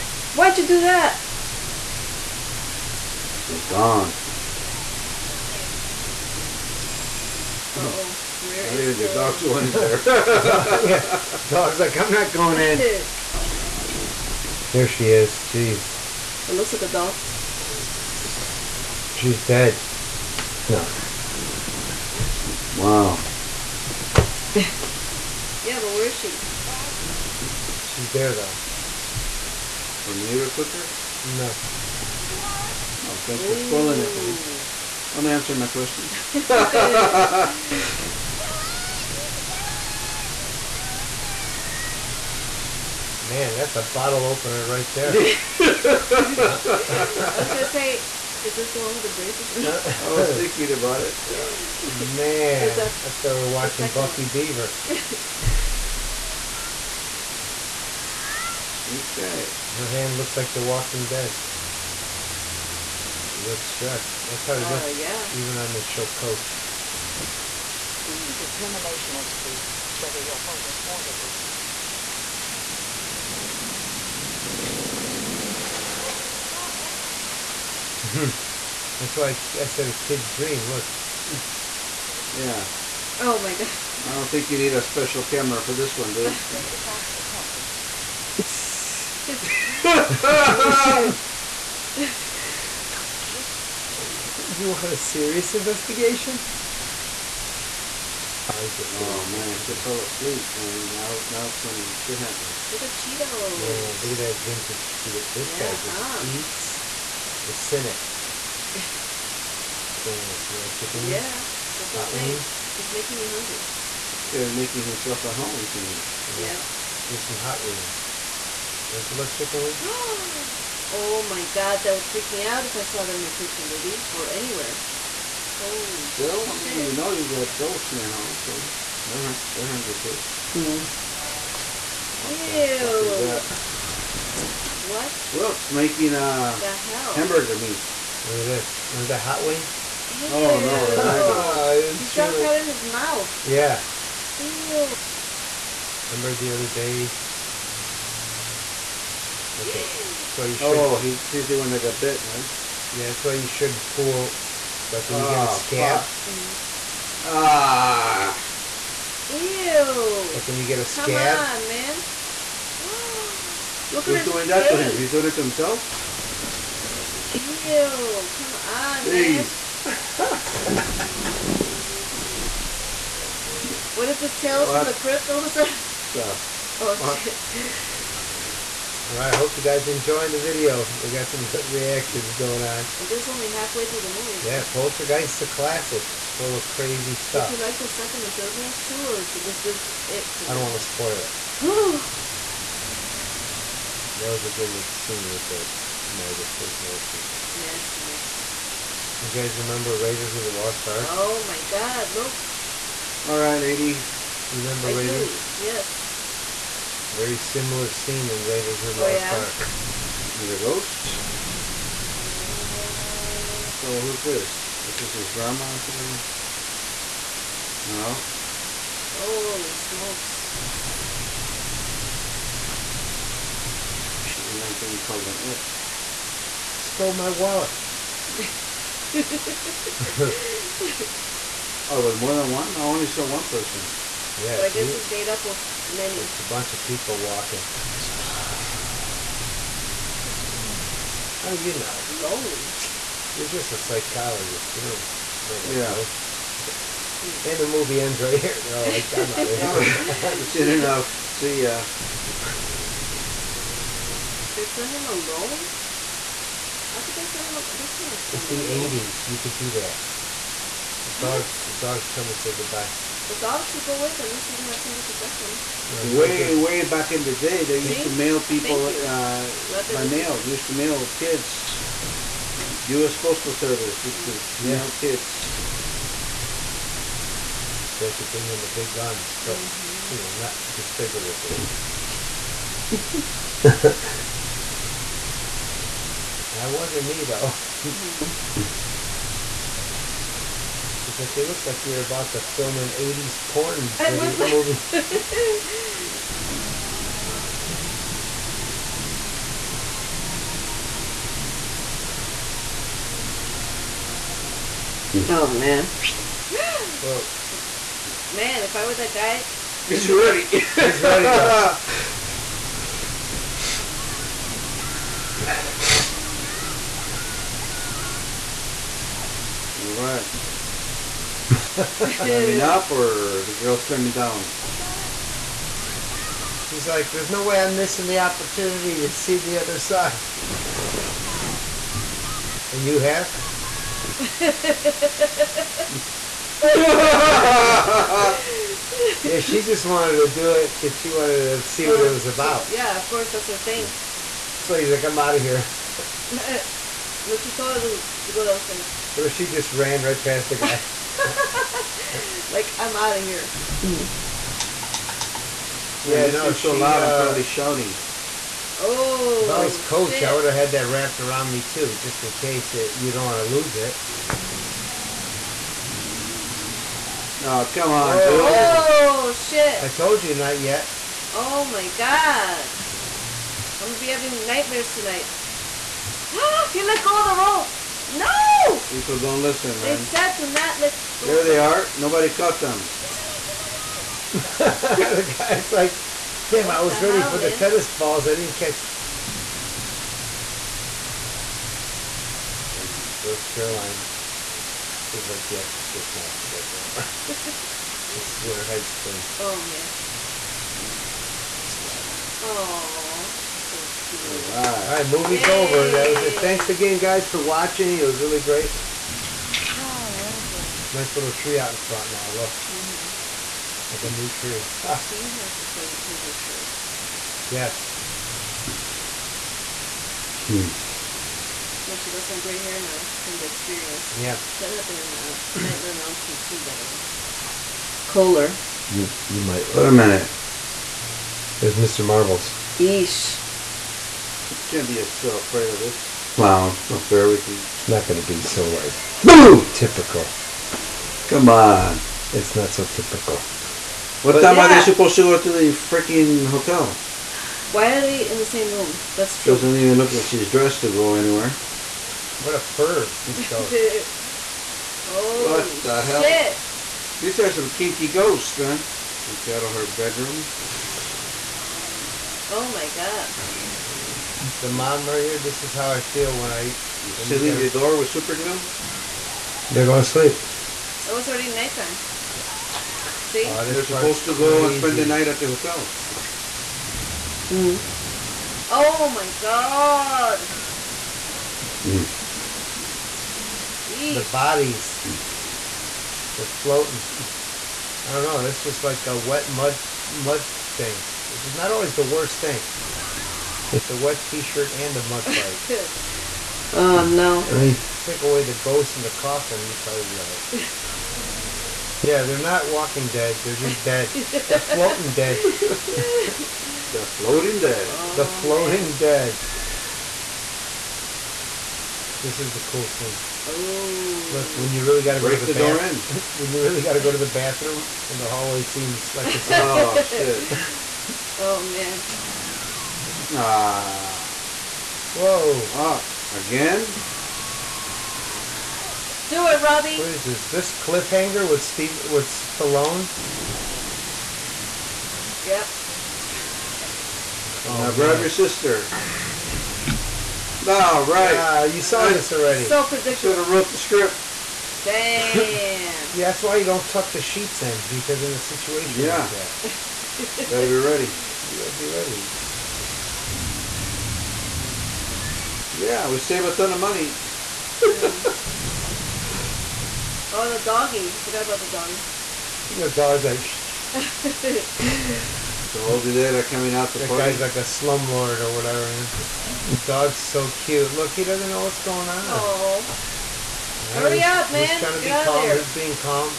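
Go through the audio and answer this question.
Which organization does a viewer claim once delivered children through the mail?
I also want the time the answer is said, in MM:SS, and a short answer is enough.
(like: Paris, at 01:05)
U.S. Postal Service, at 04:32.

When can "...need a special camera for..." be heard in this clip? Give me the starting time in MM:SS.
01:24.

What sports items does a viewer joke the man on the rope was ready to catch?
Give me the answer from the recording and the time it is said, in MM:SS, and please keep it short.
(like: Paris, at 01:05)
tennis balls, at 06:27.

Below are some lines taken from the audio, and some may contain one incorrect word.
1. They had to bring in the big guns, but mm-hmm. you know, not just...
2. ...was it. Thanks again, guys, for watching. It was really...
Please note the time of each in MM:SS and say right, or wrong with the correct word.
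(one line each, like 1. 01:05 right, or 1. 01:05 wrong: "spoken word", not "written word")
1. 04:37 right
2. 06:46 right.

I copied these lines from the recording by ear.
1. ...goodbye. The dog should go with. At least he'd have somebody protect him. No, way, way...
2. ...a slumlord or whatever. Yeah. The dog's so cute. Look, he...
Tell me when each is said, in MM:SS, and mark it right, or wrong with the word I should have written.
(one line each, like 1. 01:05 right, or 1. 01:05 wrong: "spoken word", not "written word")
1. 04:22 right
2. 09:27 right.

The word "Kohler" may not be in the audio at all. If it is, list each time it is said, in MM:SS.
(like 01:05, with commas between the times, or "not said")
07:08.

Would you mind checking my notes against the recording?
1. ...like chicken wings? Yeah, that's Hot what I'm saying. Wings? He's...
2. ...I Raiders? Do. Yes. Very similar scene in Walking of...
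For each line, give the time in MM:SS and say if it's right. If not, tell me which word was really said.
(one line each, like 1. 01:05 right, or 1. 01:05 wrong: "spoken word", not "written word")
1. 01:50 right
2. 03:24 wrong: "Raiders", not "Walking".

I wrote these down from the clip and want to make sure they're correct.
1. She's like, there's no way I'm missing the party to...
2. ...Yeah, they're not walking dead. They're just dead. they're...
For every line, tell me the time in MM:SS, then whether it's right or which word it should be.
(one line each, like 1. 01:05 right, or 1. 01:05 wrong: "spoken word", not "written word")
1. 05:26 wrong: "opportunity", not "party"
2. 08:22 right.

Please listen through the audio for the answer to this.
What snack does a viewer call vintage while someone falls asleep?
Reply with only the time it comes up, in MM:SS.
01:42.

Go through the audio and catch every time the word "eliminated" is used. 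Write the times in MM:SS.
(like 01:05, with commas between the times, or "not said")
not said.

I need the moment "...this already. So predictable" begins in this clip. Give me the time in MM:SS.
09:02.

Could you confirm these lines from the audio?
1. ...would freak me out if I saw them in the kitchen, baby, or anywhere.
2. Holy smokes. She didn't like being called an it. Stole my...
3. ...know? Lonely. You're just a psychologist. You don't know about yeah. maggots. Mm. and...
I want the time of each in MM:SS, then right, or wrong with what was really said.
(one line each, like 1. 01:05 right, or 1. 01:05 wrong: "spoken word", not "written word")
1. 02:01 right
2. 03:39 right
3. 04:01 wrong: "ghosts", not "maggots".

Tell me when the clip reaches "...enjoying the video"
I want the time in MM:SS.
02:59.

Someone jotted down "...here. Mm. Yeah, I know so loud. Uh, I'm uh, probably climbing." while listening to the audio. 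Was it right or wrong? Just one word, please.
wrong.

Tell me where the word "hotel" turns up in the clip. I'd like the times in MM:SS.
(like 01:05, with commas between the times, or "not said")
07:26, 07:55.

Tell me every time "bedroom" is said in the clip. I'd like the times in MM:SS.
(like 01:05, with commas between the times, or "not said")
07:39.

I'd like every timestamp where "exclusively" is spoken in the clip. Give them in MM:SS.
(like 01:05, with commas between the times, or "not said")
not said.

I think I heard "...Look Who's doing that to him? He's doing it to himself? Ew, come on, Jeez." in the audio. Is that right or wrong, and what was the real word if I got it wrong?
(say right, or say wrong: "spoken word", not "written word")
right.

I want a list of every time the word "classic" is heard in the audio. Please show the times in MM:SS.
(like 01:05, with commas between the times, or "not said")
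03:05.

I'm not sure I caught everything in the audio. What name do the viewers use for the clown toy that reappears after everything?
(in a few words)
Mr. Marbles.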